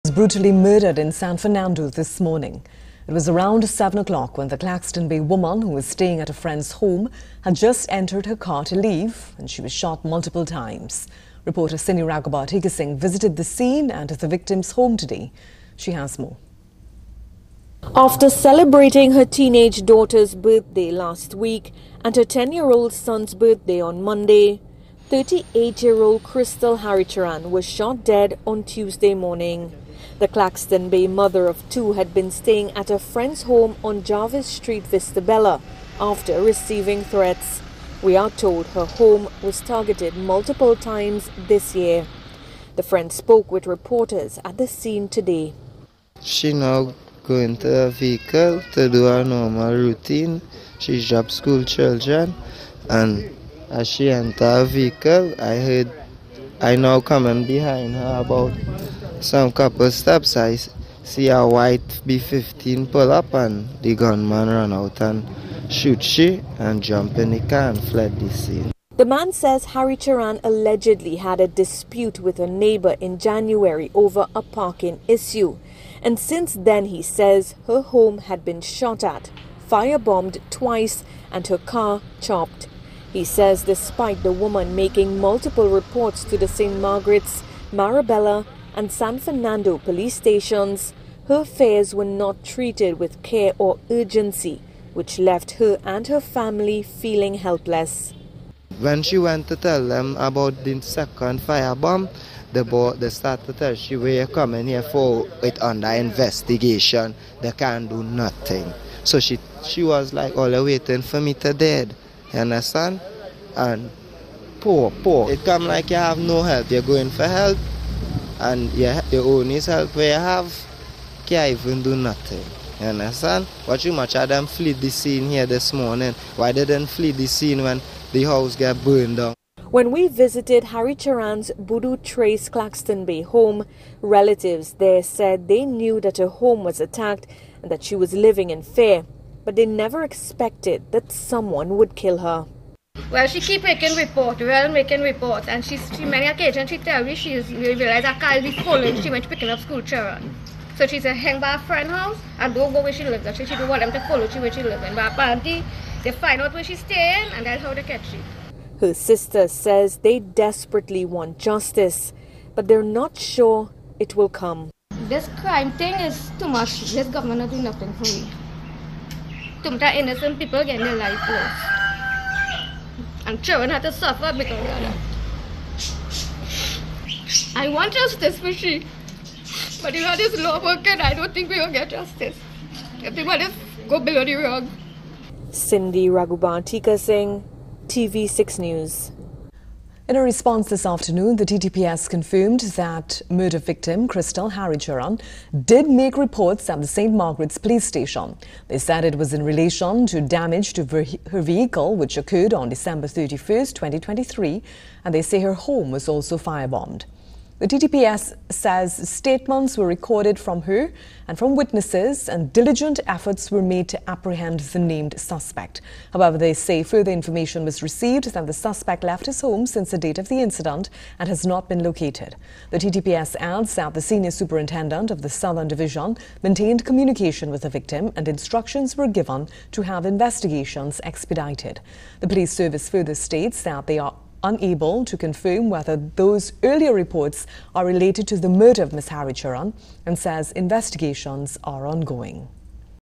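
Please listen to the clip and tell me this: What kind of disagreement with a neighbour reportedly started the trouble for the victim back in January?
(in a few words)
parking issue.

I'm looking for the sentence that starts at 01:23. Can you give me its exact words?
He says despite the woman making multiple reports to the St.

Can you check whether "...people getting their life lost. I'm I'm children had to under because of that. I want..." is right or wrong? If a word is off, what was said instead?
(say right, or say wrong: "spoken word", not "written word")
wrong: "suffer", not "under".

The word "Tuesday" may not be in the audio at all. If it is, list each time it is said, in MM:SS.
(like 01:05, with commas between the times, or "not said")
00:28.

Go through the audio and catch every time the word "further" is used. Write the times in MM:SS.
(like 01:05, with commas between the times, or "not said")
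03:36, 03:52.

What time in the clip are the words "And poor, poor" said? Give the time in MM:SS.
01:53.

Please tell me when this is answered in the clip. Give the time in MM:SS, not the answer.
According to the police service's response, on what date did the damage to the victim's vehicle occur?
03:22.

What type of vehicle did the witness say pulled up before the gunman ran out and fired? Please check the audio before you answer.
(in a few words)
white B-15.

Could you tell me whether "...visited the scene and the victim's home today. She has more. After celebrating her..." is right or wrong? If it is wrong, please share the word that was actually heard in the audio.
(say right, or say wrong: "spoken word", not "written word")
right.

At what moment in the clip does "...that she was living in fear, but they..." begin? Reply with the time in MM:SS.
02:17.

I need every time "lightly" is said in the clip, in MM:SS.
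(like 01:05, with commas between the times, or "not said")
not said.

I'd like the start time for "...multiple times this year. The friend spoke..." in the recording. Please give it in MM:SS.
00:40.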